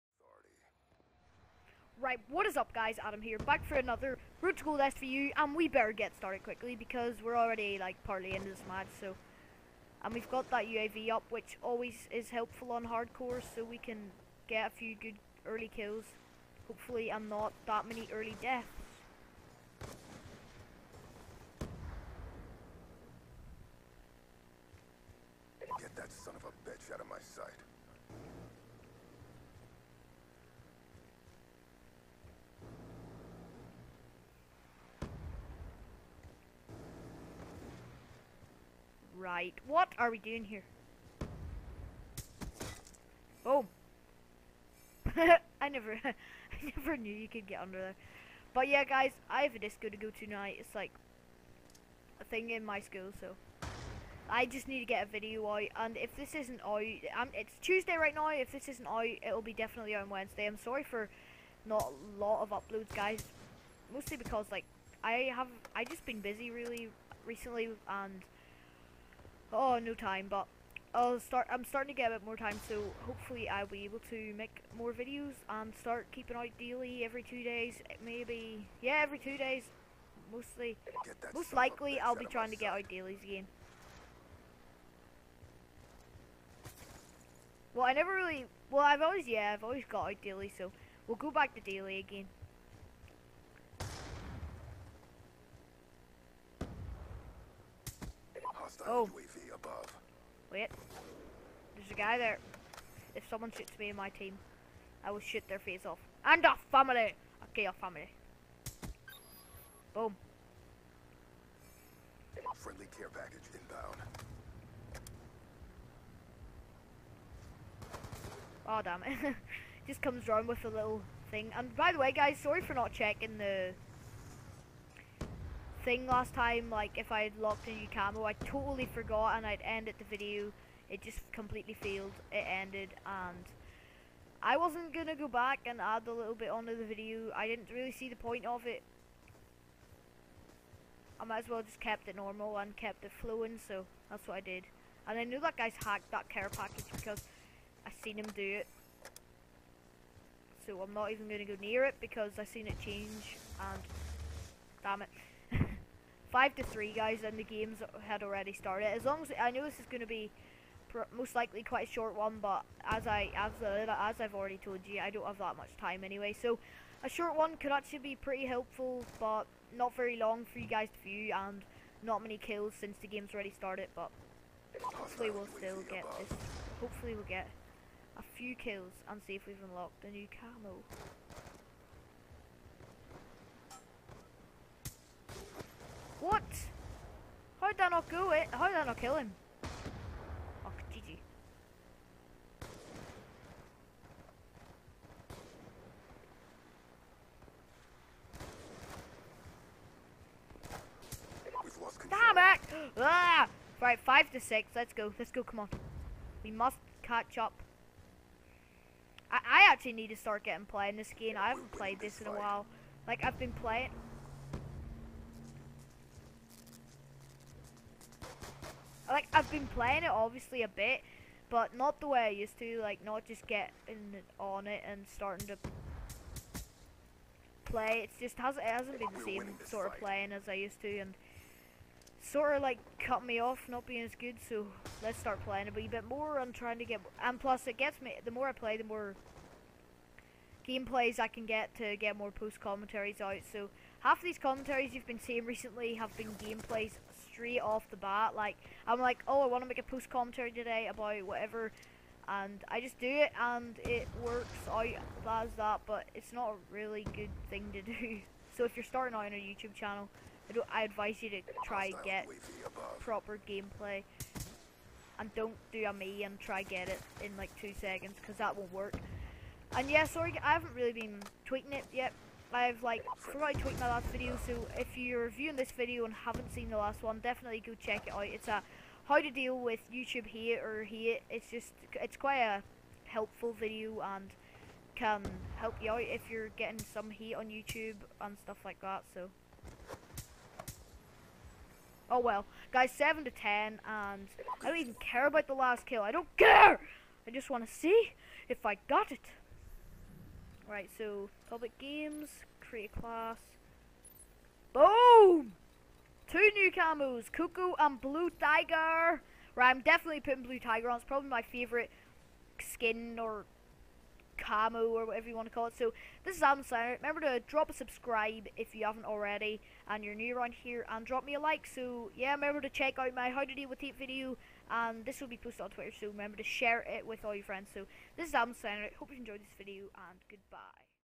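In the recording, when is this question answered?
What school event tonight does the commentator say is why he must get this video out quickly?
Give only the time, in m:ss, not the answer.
0:49.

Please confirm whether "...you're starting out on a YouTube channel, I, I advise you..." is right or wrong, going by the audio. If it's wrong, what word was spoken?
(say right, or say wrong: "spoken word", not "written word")
right.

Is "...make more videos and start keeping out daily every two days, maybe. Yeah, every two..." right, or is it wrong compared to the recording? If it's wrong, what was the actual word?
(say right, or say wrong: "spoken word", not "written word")
right.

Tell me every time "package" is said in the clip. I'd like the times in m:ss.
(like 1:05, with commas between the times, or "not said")
1:53, 2:26.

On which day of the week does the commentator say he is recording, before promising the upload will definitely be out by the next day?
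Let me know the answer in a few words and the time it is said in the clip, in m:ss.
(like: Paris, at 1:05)
Tuesday, at 0:57.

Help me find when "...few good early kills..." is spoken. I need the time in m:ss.
0:14.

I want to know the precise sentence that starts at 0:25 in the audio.
Get that son of a bitch out of my sight.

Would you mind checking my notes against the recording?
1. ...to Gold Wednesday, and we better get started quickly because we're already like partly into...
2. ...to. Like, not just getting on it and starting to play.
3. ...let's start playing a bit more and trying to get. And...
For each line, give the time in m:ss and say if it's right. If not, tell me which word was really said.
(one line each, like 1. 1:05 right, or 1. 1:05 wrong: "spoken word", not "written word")
1. 0:04 wrong: "SVU", not "Wednesday"
2. 3:42 right
3. 3:55 right.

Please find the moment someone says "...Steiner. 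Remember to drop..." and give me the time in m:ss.
5:16.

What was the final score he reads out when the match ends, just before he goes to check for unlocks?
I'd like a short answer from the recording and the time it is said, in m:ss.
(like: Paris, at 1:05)
7 to 10, at 4:52.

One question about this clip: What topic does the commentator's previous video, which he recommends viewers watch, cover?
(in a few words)
How to deal with YouTube hate.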